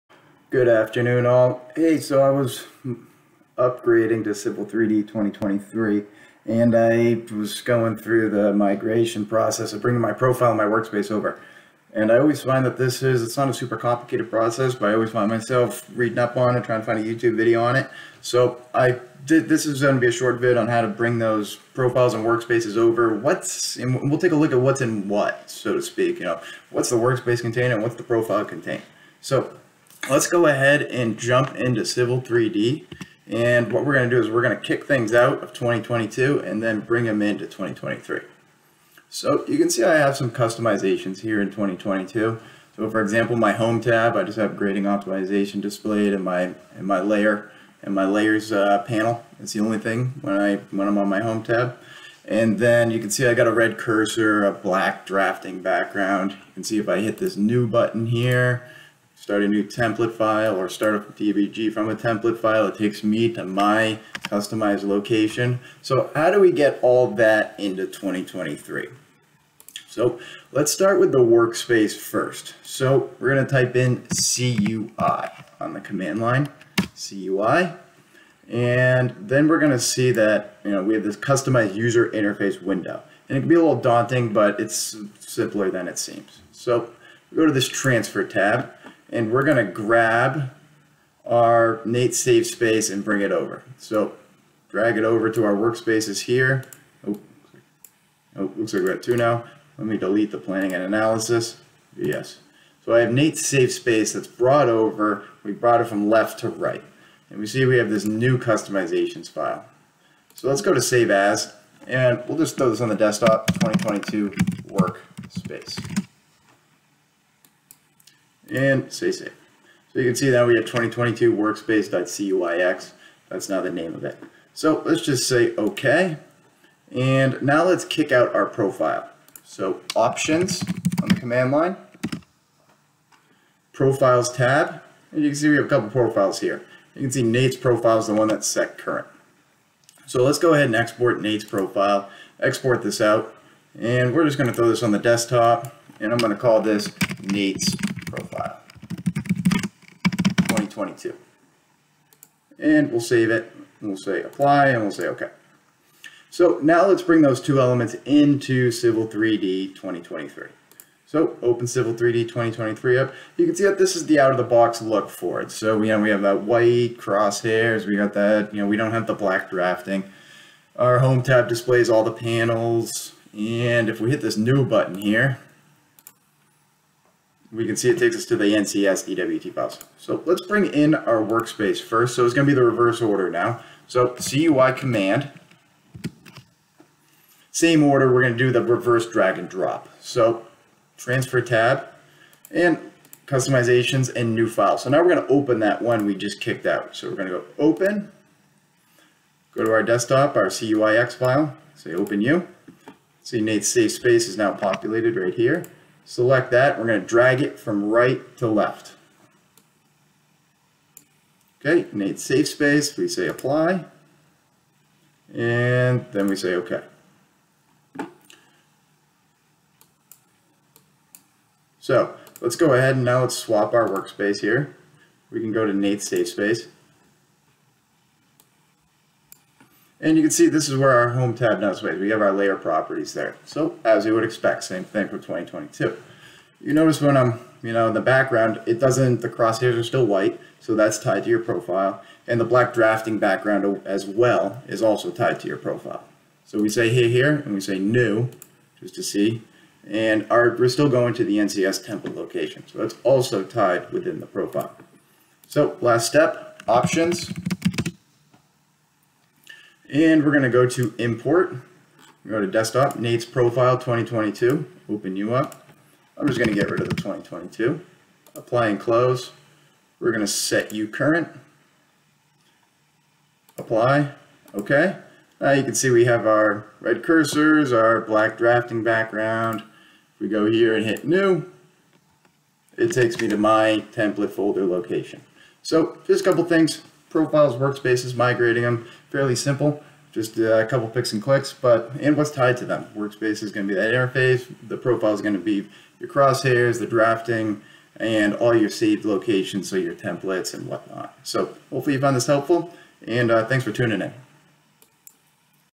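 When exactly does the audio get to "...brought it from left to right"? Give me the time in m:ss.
1:45.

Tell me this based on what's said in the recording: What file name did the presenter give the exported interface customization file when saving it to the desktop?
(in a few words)
2022 workspace.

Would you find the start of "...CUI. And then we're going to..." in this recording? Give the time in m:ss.
1:16.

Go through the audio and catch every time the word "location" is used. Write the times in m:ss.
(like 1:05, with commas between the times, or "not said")
1:04, 4:12, 4:44, 4:59.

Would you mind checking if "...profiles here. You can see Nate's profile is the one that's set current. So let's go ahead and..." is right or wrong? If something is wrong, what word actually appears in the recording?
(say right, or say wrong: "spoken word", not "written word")
right.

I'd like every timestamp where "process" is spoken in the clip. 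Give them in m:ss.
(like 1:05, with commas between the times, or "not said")
0:09, 0:14.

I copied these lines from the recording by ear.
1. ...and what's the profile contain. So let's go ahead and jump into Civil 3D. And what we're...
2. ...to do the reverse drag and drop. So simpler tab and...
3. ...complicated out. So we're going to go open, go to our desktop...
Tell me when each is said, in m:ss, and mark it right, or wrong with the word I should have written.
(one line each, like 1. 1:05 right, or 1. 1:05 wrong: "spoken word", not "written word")
1. 0:27 right
2. 3:08 wrong: "transfer", not "simpler"
3. 3:16 wrong: "kicked", not "complicated".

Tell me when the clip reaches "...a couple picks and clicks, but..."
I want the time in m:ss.
4:50.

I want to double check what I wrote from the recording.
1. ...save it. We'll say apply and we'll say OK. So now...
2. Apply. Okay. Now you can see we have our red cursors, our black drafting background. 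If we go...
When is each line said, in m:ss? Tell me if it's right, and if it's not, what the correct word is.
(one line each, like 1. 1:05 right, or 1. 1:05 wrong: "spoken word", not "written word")
1. 2:33 right
2. 4:33 right.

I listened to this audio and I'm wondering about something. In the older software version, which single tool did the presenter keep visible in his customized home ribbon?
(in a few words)
grading optimization.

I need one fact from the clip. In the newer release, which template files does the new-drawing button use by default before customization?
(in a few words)
NCS DWT files.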